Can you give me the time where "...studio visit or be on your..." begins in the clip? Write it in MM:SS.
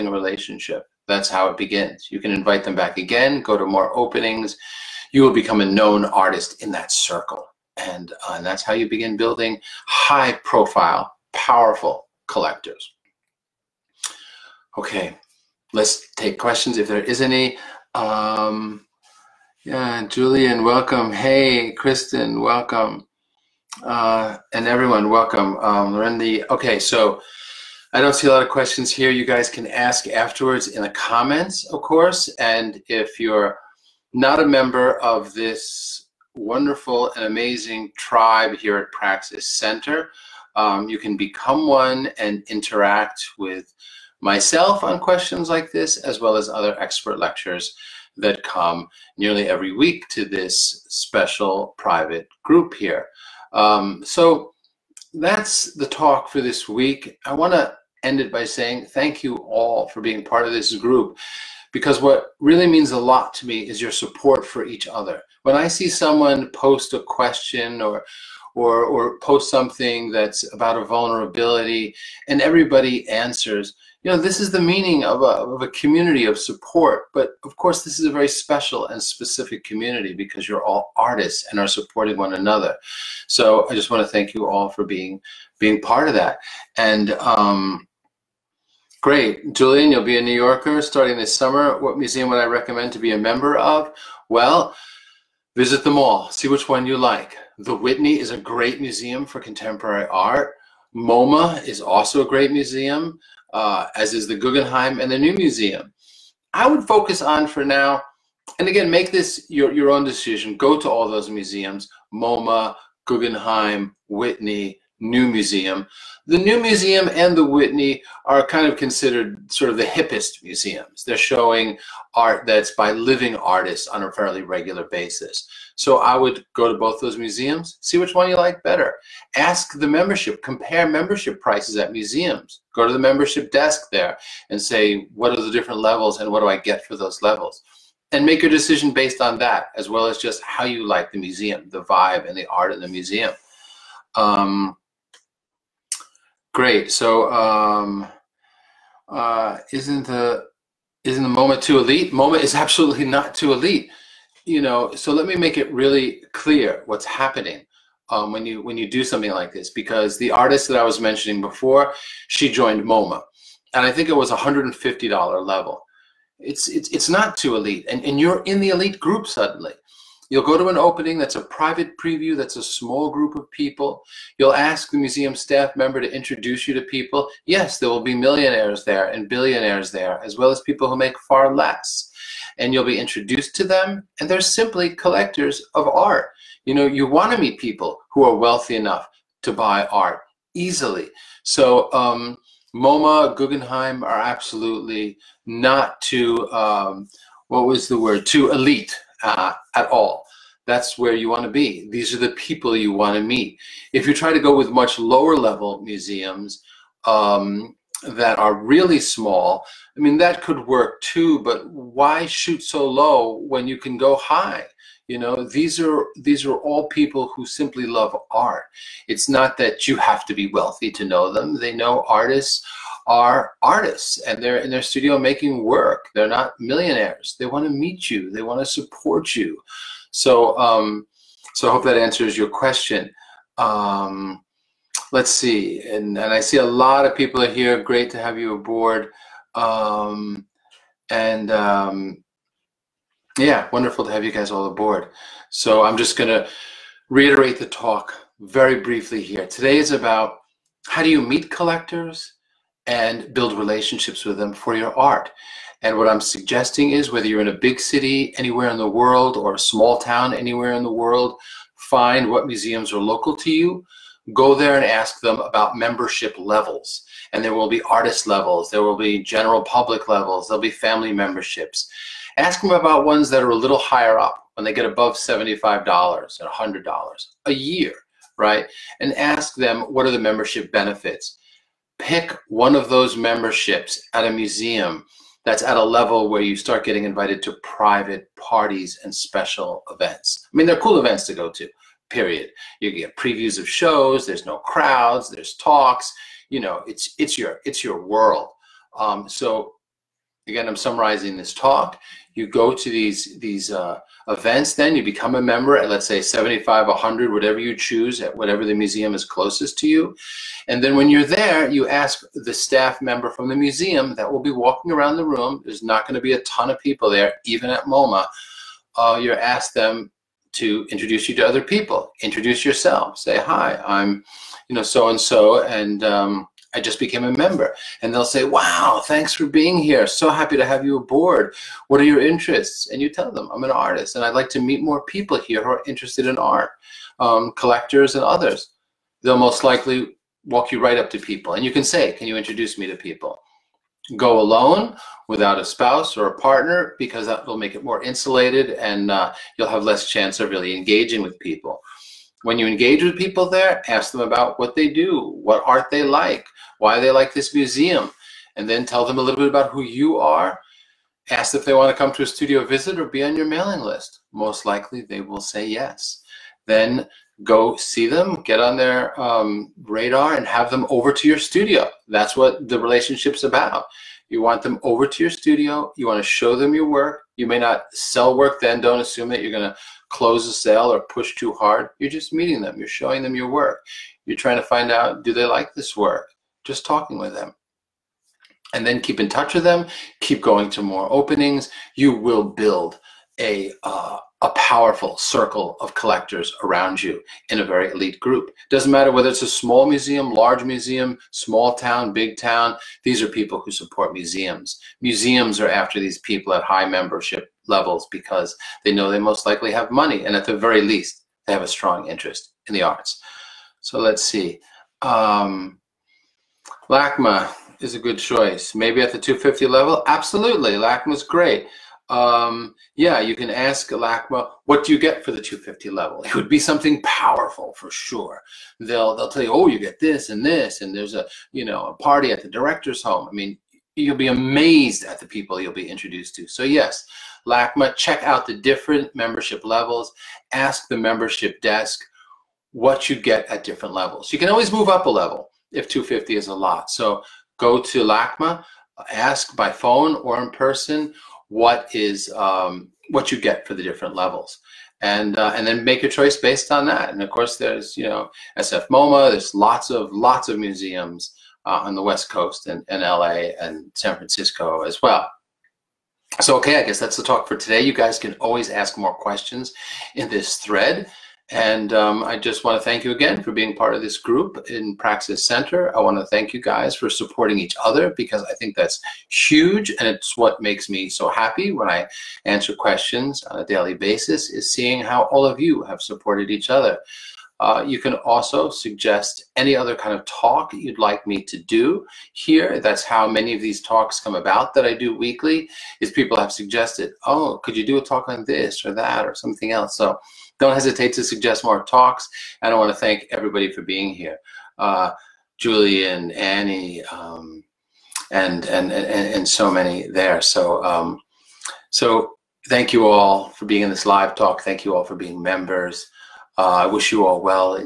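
06:02.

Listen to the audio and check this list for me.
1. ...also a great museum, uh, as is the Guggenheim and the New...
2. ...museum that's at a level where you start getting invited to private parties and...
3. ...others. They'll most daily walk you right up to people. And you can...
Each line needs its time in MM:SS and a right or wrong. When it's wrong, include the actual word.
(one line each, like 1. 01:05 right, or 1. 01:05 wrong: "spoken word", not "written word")
1. 01:41 right
2. 04:44 right
3. 05:38 wrong: "likely", not "daily".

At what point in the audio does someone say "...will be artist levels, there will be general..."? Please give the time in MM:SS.
04:27.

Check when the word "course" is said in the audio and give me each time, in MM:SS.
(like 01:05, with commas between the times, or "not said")
00:31, 01:17, 07:37.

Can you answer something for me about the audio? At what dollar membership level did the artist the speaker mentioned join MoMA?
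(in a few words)
$150.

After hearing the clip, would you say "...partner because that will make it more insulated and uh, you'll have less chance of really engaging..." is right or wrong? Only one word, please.
right.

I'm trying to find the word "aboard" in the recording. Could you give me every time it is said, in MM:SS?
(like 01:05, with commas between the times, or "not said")
03:58, 04:04, 05:30.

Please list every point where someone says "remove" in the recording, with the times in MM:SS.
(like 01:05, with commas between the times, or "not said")
not said.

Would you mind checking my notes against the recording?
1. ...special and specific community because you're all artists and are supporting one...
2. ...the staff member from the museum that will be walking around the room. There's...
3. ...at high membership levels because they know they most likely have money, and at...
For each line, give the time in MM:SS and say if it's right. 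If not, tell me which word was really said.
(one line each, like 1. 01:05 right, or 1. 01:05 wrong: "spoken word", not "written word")
1. 01:18 right
2. 05:12 right
3. 06:46 right.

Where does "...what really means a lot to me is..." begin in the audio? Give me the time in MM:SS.
01:02.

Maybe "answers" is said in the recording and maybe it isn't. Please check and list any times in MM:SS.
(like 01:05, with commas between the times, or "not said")
01:13, 03:51, 08:02.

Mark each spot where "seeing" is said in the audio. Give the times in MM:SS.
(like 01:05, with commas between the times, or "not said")
08:04.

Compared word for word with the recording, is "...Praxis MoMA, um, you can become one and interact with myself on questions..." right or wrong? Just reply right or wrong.
wrong.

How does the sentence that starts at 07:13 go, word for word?
I mean, you'll be amazed at the people you'll be introduced to.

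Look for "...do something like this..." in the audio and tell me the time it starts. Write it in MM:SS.
02:38.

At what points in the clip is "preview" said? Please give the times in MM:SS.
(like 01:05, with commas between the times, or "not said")
02:51, 04:53.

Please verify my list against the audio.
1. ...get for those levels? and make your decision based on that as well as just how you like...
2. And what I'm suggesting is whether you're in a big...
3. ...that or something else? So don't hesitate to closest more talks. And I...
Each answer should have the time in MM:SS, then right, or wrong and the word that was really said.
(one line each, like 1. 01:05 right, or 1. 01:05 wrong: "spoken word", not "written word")
1. 02:16 right
2. 04:15 right
3. 08:18 wrong: "suggest", not "closest".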